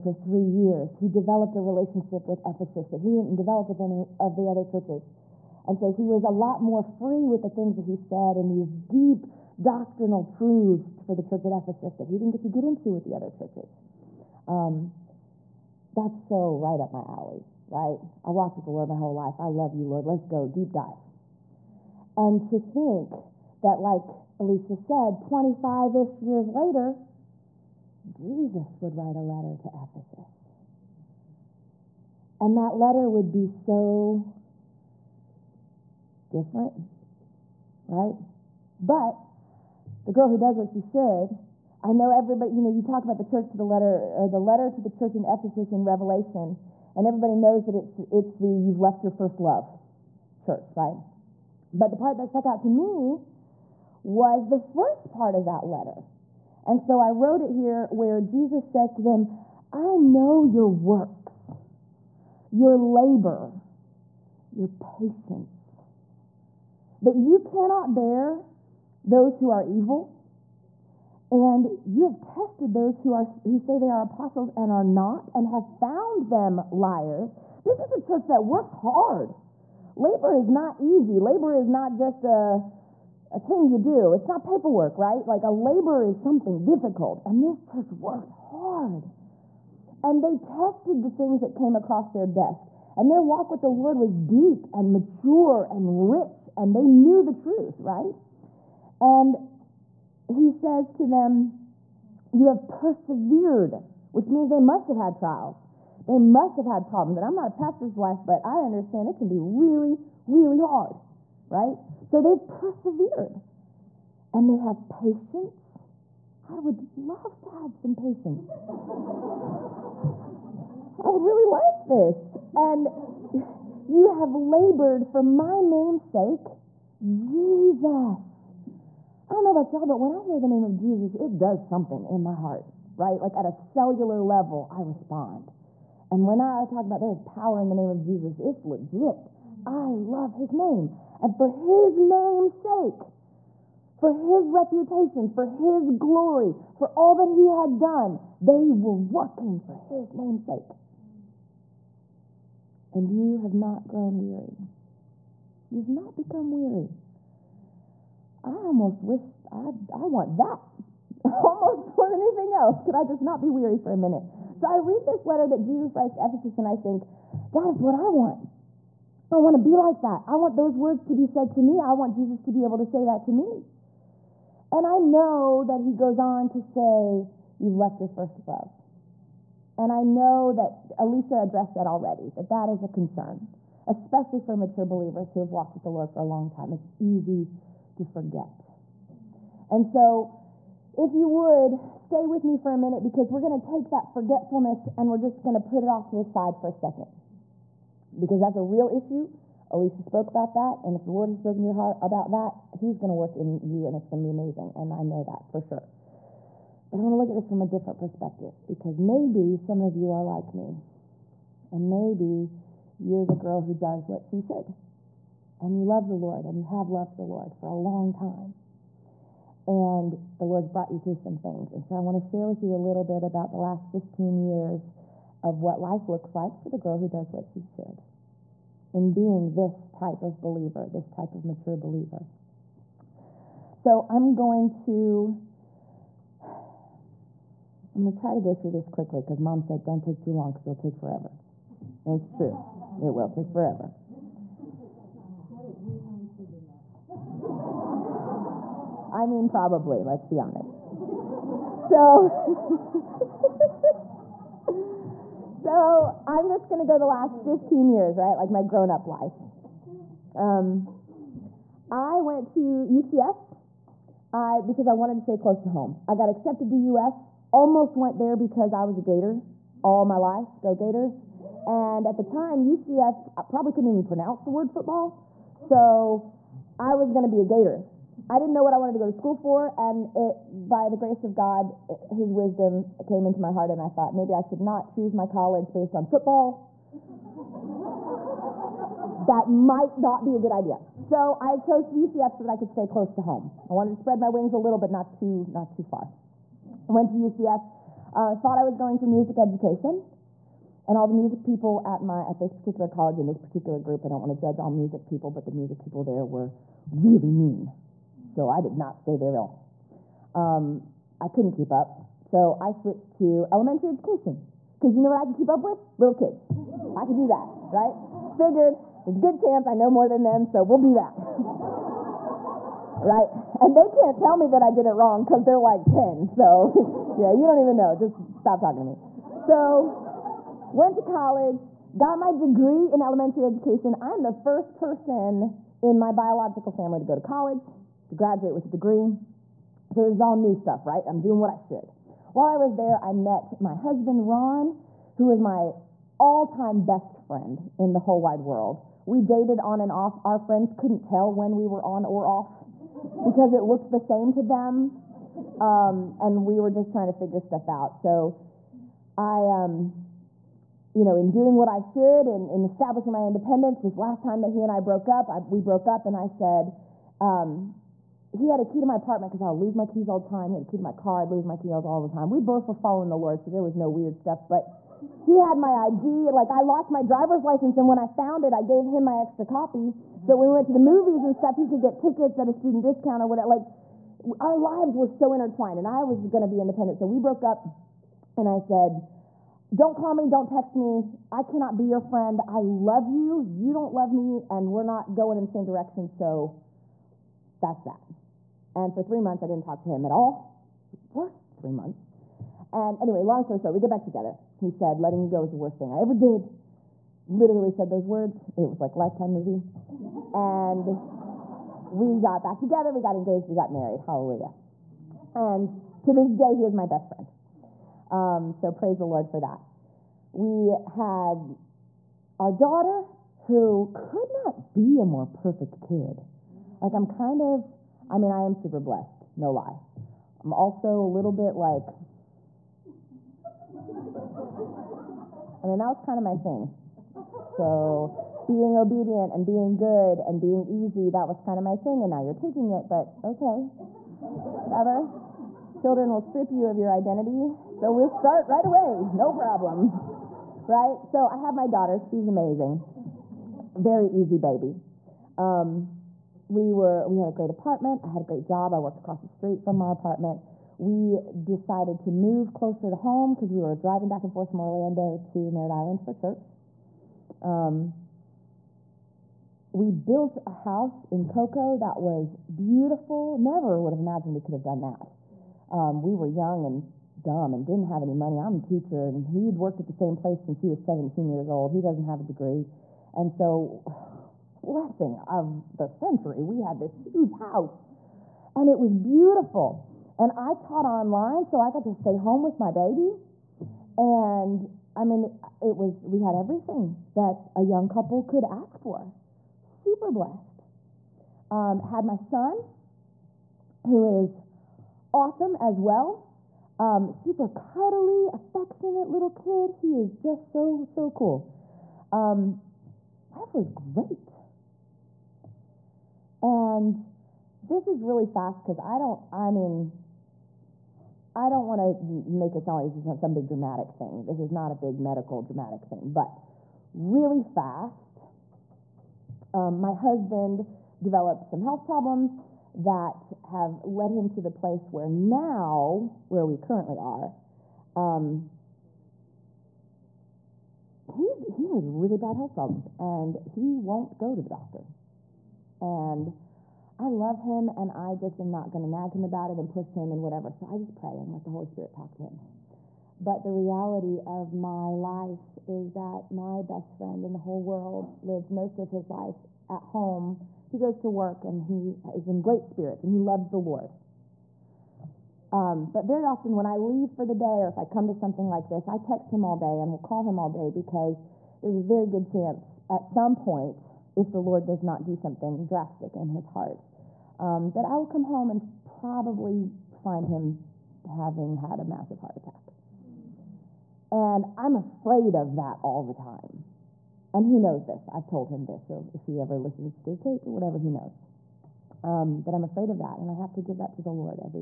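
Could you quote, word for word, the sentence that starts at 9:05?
And I love him and I just am not going to nag him about it and push him and whatever.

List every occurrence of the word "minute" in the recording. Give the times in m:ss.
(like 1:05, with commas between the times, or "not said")
2:43, 3:12.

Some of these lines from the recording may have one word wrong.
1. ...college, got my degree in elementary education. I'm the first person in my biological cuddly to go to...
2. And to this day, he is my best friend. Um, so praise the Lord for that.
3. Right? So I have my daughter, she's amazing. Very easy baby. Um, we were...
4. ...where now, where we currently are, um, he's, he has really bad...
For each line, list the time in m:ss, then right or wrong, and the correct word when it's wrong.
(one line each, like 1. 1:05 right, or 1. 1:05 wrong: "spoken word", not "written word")
1. 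5:31 wrong: "family", not "cuddly"
2. 6:55 right
3. 7:30 right
4. 8:54 right.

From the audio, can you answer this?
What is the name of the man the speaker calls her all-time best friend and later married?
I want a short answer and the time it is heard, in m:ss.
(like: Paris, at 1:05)
Ron, at 5:44.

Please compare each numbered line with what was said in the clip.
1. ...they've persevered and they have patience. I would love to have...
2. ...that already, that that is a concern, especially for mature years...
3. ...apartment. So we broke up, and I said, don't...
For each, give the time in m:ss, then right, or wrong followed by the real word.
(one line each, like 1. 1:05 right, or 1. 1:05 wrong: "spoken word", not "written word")
1. 1:52 right
2. 3:01 wrong: "believers", not "years"
3. 6:26 wrong: "independent", not "apartment".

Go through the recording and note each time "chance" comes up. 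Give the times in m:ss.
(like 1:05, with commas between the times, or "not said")
5:19, 9:32.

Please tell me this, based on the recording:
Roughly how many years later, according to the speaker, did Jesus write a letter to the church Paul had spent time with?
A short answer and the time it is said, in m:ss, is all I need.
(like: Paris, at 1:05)
25, at 0:25.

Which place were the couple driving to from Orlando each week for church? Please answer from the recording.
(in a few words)
Merritt Island.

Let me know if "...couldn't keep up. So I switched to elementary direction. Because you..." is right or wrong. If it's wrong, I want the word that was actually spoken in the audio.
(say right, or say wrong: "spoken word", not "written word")
wrong: "education", not "direction".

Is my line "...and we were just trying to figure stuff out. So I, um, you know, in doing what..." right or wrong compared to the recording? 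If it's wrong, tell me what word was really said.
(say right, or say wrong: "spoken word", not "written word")
right.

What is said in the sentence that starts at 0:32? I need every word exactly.
And that letter would be so different, right?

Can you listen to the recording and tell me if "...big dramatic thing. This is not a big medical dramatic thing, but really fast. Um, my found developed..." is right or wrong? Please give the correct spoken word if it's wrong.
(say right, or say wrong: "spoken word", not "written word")
wrong: "husband", not "found".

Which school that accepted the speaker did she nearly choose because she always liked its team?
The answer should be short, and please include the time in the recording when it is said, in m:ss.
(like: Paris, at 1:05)
UF, at 4:26.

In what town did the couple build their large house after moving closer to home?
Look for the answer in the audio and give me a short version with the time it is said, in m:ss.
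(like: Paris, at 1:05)
Cocoa, at 7:51.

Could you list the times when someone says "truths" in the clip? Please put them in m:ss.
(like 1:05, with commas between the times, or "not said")
0:10, 1:37.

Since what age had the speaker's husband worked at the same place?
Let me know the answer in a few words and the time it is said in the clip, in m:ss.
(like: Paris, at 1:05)
17, at 8:00.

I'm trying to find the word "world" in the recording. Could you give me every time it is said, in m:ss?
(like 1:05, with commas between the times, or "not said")
5:48, 9:17.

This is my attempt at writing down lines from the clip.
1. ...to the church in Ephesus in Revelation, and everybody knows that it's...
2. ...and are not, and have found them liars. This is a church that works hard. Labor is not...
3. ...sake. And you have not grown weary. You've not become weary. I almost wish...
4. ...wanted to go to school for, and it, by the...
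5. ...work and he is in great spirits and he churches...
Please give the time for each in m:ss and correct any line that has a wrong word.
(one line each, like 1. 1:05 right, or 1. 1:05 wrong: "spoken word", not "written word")
1. 0:44 right
2. 1:14 right
3. 2:30 right
4. 4:38 right
5. 9:21 wrong: "loves", not "churches".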